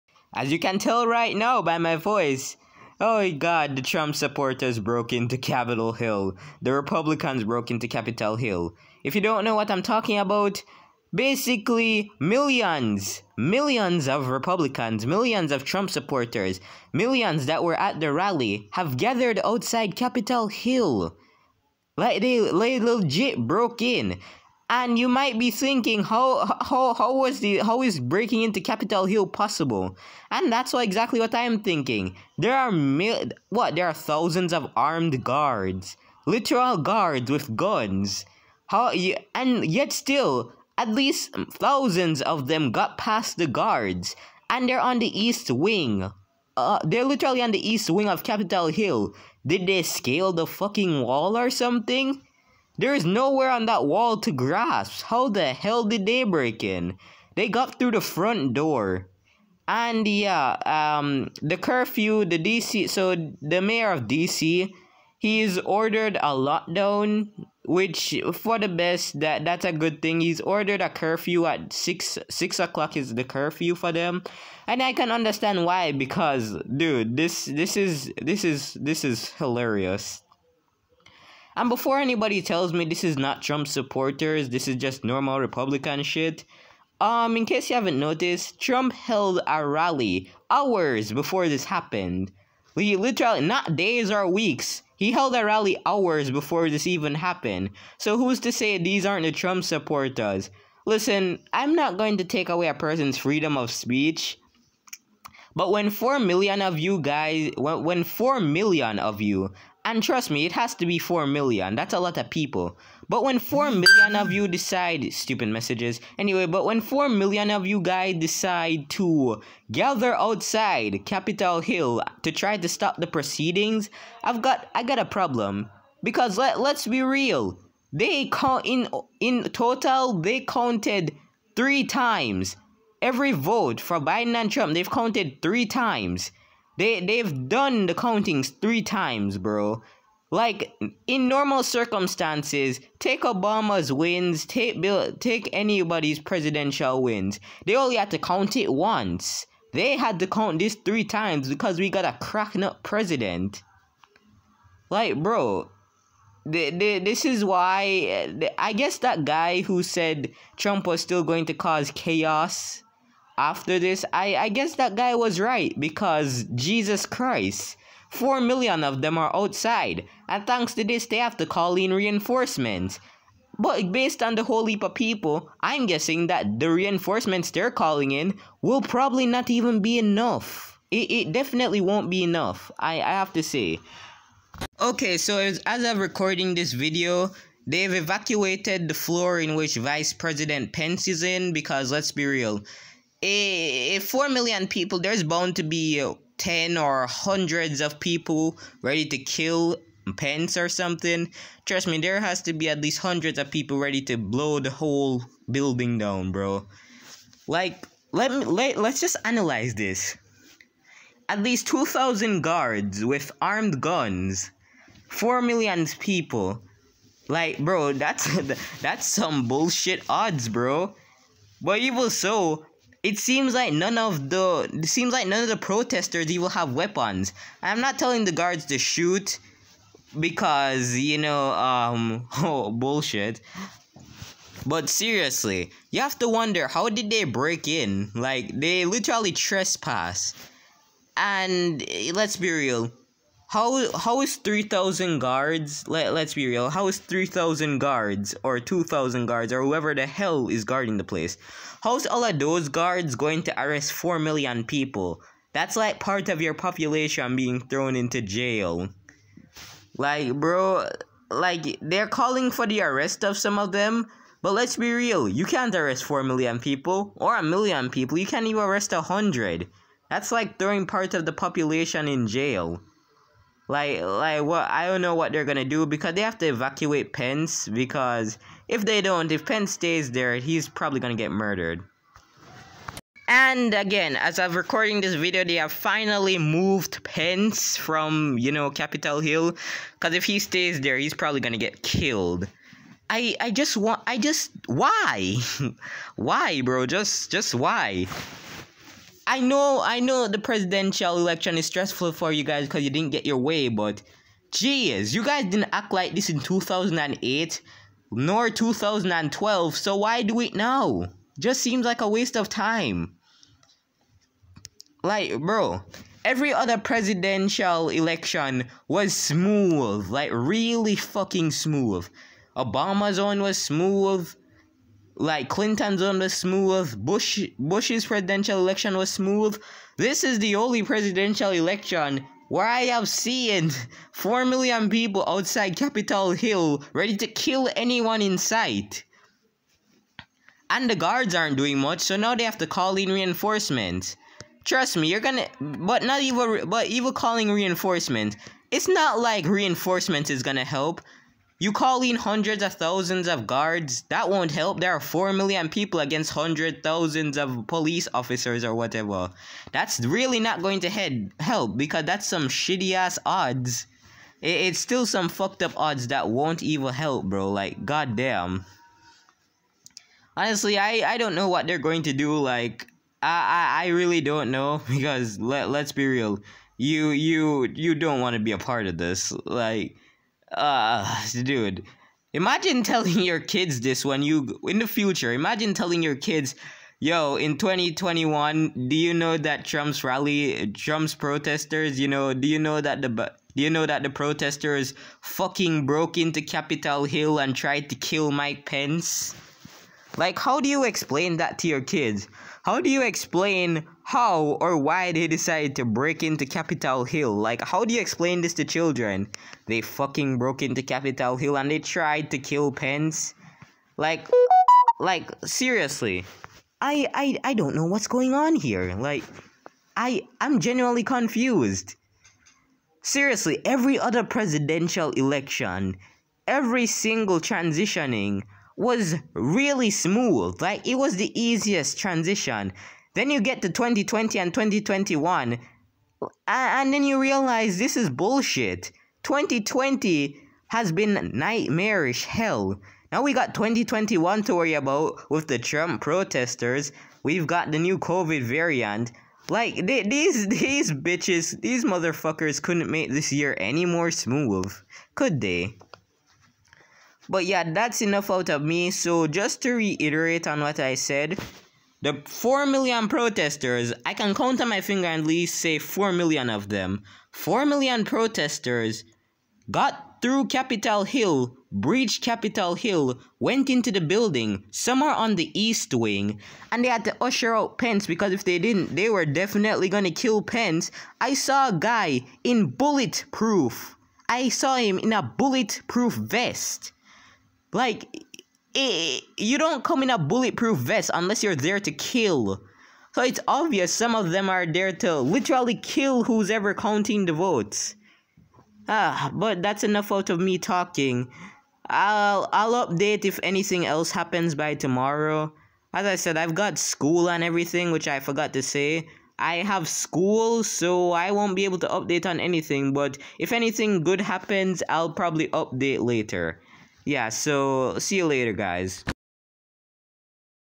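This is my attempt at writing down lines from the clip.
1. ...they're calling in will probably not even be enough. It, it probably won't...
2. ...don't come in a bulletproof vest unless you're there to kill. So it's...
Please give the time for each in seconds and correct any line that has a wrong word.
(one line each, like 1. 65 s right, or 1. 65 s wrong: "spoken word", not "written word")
1. 177 s wrong: "definitely", not "probably"
2. 489 s right.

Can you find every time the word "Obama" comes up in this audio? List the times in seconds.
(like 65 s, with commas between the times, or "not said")
143 s, 322 s.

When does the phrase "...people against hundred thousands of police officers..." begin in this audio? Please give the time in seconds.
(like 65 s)
355 s.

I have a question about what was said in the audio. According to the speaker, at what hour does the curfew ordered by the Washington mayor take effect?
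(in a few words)
6 o'clock.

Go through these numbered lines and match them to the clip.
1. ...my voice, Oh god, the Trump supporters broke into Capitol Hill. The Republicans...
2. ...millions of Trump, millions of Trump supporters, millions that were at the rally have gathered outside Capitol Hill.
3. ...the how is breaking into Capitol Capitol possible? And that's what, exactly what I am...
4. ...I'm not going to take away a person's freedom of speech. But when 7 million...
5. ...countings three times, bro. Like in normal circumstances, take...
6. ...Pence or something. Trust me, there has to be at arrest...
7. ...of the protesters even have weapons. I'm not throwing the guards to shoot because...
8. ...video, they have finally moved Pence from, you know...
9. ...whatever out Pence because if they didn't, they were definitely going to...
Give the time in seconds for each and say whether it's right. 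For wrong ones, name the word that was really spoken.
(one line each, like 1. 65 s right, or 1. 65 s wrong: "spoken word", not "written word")
1. 1 s right
2. 13 s wrong: "Republicans", not "Trump"
3. 27 s wrong: "Hill", not "Capitol"
4. 101 s wrong: "4", not "7"
5. 137 s right
6. 200 s wrong: "least", not "arrest"
7. 225 s wrong: "telling", not "throwing"
8. 285 s right
9. 477 s wrong: "usher", not "whatever".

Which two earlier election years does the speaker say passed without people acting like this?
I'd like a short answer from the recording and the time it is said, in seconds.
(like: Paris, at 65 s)
2008 and 2012, at 306 s.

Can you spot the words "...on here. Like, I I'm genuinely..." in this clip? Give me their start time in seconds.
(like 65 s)
418 s.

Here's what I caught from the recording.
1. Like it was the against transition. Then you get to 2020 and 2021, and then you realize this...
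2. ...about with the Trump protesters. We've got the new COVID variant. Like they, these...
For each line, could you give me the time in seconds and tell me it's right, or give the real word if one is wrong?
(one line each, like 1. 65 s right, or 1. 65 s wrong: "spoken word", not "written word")
1. 430 s wrong: "easiest", not "against"
2. 444 s right.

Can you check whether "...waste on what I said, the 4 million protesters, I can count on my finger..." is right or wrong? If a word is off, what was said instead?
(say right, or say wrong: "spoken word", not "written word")
wrong: "reiterate", not "waste".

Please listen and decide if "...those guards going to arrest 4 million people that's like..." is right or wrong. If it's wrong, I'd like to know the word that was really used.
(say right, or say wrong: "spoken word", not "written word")
right.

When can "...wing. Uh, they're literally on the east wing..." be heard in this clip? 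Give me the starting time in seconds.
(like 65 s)
45 s.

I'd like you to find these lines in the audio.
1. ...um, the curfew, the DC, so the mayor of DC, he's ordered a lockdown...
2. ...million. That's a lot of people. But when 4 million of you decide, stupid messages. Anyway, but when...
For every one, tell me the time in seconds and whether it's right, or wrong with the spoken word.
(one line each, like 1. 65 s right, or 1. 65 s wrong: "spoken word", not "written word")
1. 60 s right
2. 111 s right.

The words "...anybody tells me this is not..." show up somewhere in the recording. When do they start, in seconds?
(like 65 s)
81 s.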